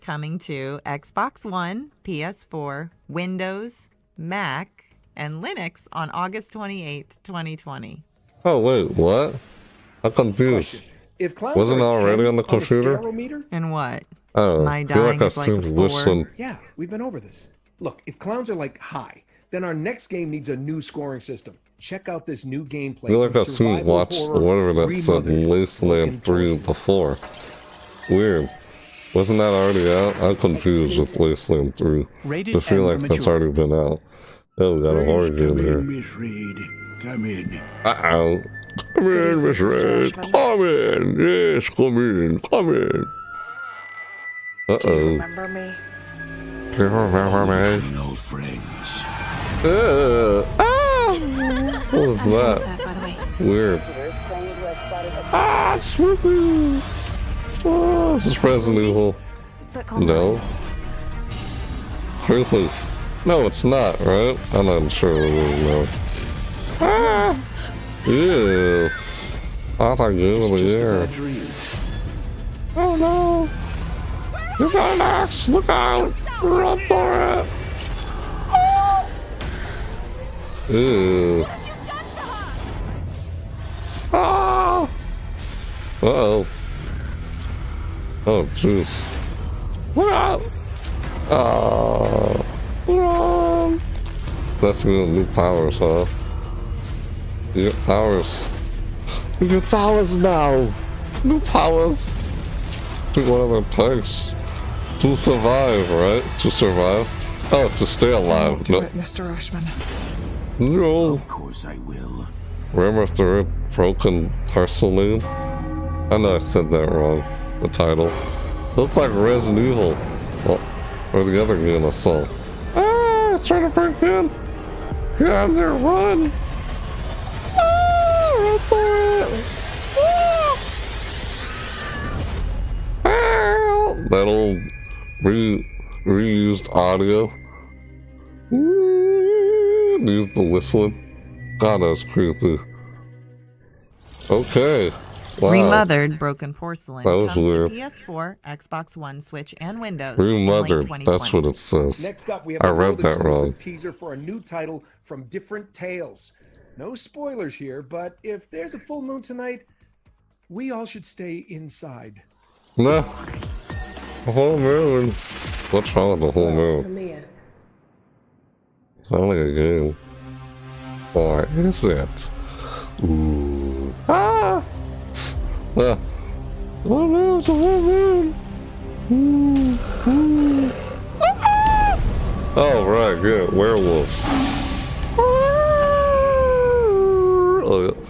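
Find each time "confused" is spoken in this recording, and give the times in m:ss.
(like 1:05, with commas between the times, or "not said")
0:10, 0:30.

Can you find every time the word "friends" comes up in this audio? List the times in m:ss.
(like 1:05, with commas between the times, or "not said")
0:48.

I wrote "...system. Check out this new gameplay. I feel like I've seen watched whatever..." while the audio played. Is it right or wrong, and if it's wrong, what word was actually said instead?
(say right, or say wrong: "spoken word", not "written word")
right.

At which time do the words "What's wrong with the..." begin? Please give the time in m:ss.
2:45.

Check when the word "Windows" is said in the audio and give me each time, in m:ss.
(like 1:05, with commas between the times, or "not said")
0:03, 2:29.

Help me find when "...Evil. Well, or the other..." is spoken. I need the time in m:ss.
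1:59.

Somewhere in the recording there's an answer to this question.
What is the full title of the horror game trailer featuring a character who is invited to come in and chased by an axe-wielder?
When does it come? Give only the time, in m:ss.
2:25.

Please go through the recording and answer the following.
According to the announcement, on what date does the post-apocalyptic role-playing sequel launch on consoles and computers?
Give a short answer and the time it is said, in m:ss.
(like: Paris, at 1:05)
August 28th, 2020, at 0:06.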